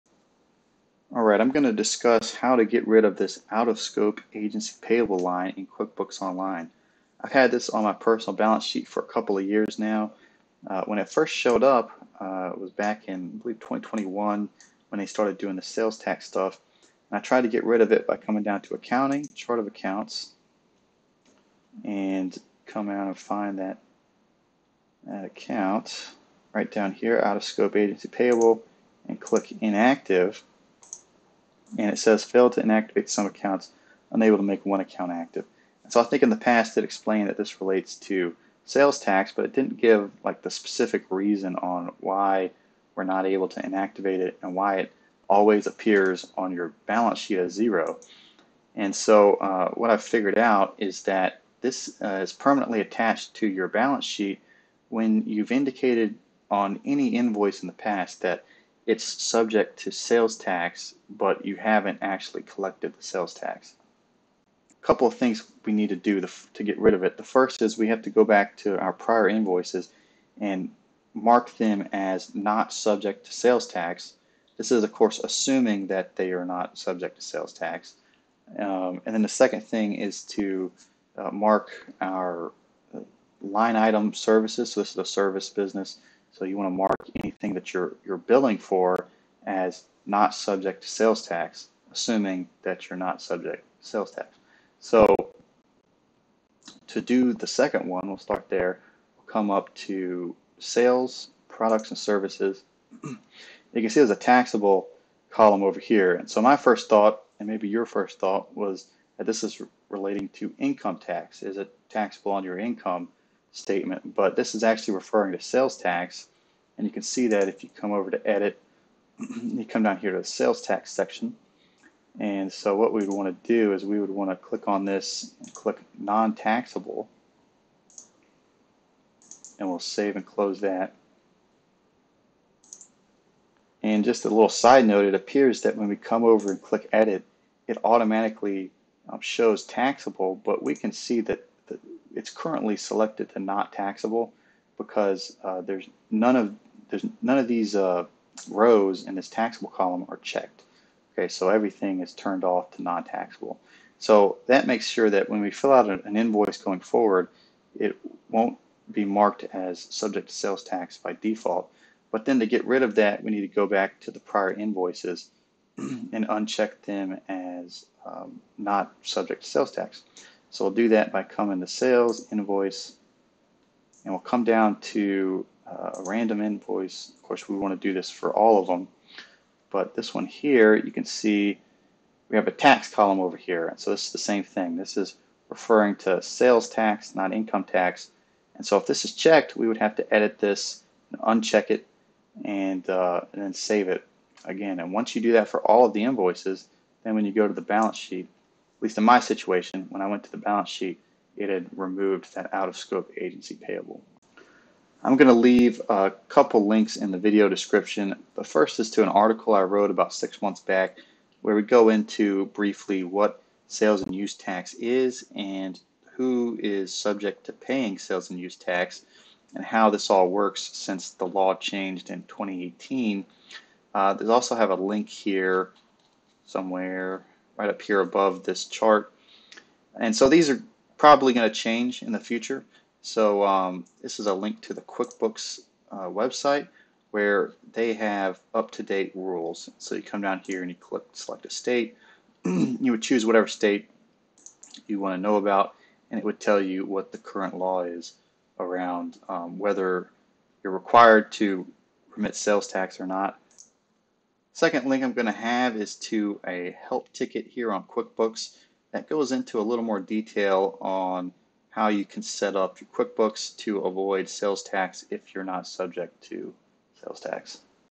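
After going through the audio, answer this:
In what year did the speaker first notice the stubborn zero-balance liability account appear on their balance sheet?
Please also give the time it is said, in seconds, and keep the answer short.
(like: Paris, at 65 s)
2021, at 13 s.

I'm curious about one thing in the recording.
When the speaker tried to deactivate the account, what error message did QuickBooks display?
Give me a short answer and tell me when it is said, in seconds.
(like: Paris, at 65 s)
Failed to inactivate some accounts, at 32 s.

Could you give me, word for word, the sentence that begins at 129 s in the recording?
And we'll save and close that.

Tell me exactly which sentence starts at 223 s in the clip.
Uh, there's also have a link here somewhere right up here above this chart.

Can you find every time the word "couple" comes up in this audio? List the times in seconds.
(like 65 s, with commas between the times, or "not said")
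9 s, 64 s, 206 s.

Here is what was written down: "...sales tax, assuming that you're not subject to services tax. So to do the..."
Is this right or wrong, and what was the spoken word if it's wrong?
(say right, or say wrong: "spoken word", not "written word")
wrong: "sales", not "services".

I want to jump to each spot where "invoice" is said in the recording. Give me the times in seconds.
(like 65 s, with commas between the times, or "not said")
57 s, 69 s, 156 s, 164 s, 172 s, 176 s, 196 s.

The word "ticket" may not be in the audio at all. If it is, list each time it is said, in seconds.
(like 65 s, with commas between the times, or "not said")
257 s.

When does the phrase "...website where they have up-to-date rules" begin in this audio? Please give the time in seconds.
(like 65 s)
236 s.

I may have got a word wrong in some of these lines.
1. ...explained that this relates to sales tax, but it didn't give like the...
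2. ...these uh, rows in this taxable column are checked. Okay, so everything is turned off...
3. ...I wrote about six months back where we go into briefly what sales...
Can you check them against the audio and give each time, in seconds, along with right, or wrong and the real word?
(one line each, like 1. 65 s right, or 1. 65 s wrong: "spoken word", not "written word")
1. 36 s right
2. 147 s right
3. 209 s right.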